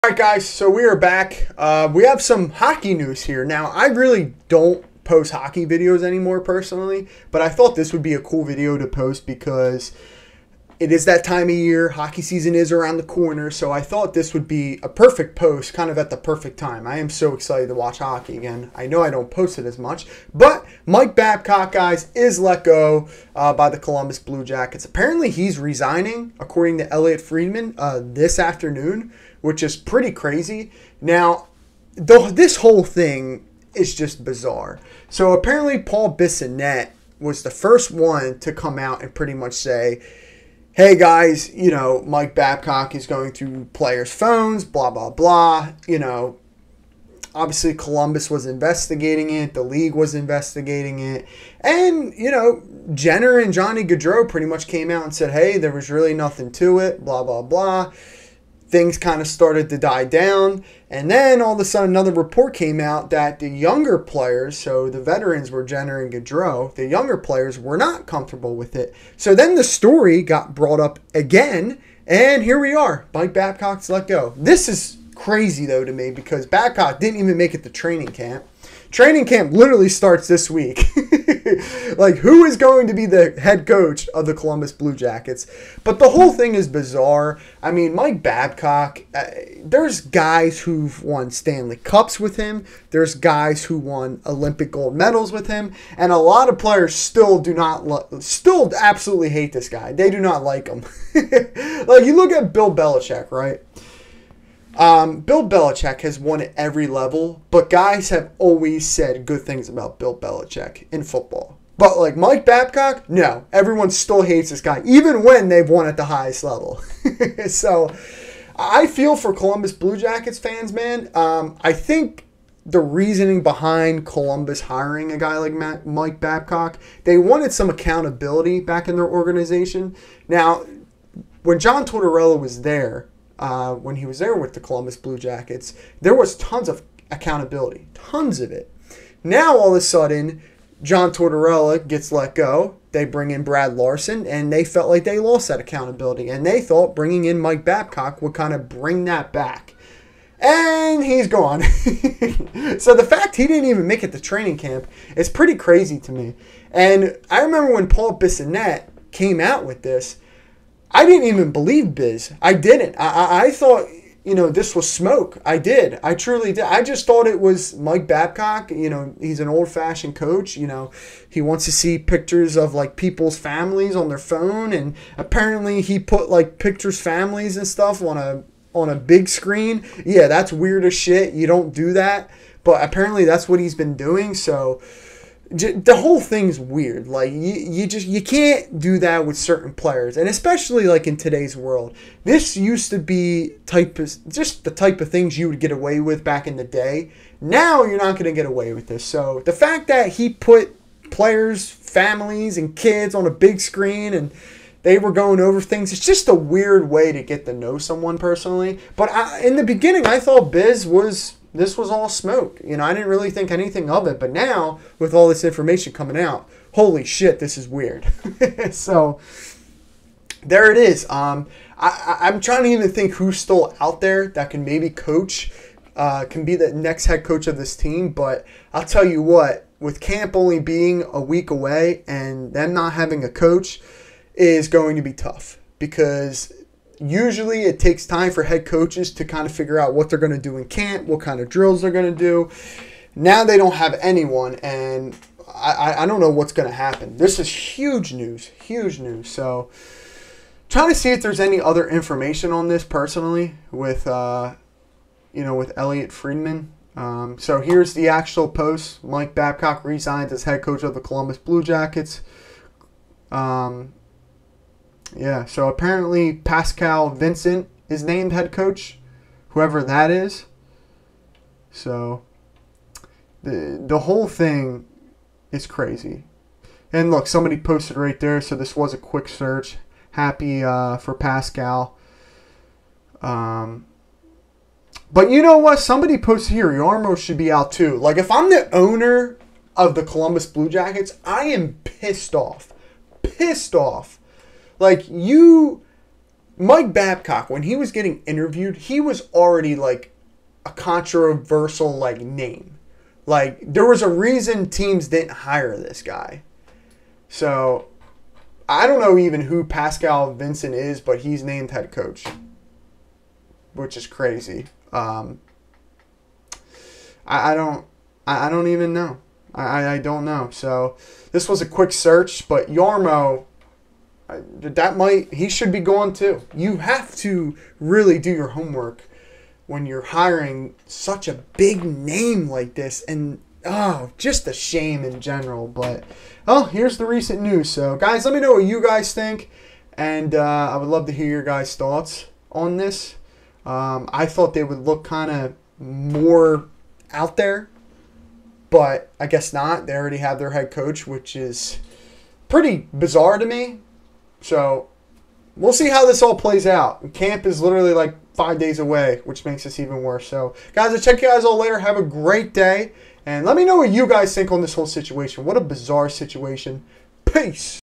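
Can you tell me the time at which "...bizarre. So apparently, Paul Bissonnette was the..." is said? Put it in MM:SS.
00:34.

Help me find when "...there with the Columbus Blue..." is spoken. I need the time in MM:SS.
02:14.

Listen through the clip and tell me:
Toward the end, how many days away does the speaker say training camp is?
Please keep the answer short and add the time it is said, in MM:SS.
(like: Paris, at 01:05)
5, at 05:58.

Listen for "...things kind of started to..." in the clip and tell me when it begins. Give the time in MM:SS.
00:58.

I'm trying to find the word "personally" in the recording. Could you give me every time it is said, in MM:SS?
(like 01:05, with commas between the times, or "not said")
00:06, 03:28, 04:12.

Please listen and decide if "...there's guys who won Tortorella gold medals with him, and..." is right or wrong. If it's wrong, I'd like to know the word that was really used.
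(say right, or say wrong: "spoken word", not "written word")
wrong: "Olympic", not "Tortorella".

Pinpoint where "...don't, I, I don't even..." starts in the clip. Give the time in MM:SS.
05:17.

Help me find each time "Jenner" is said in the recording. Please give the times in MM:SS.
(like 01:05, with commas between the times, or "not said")
00:52, 01:05.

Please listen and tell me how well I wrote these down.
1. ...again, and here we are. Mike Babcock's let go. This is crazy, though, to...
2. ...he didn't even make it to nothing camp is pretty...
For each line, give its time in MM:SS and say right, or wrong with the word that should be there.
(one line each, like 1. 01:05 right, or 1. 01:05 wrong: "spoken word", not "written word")
1. 01:11 right
2. 02:33 wrong: "training", not "nothing".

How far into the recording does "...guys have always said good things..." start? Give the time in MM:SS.
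01:47.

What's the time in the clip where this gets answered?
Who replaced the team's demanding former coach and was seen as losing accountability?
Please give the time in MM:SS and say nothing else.
02:23.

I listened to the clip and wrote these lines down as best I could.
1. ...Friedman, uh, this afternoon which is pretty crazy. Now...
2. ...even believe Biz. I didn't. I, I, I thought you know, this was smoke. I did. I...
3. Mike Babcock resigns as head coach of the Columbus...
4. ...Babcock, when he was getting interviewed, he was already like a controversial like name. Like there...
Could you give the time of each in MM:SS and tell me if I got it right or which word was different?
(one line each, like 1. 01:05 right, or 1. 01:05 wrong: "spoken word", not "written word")
1. 00:27 right
2. 02:41 right
3. 04:19 right
4. 04:56 right.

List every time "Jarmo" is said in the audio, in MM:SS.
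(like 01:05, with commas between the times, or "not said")
04:46, 05:22.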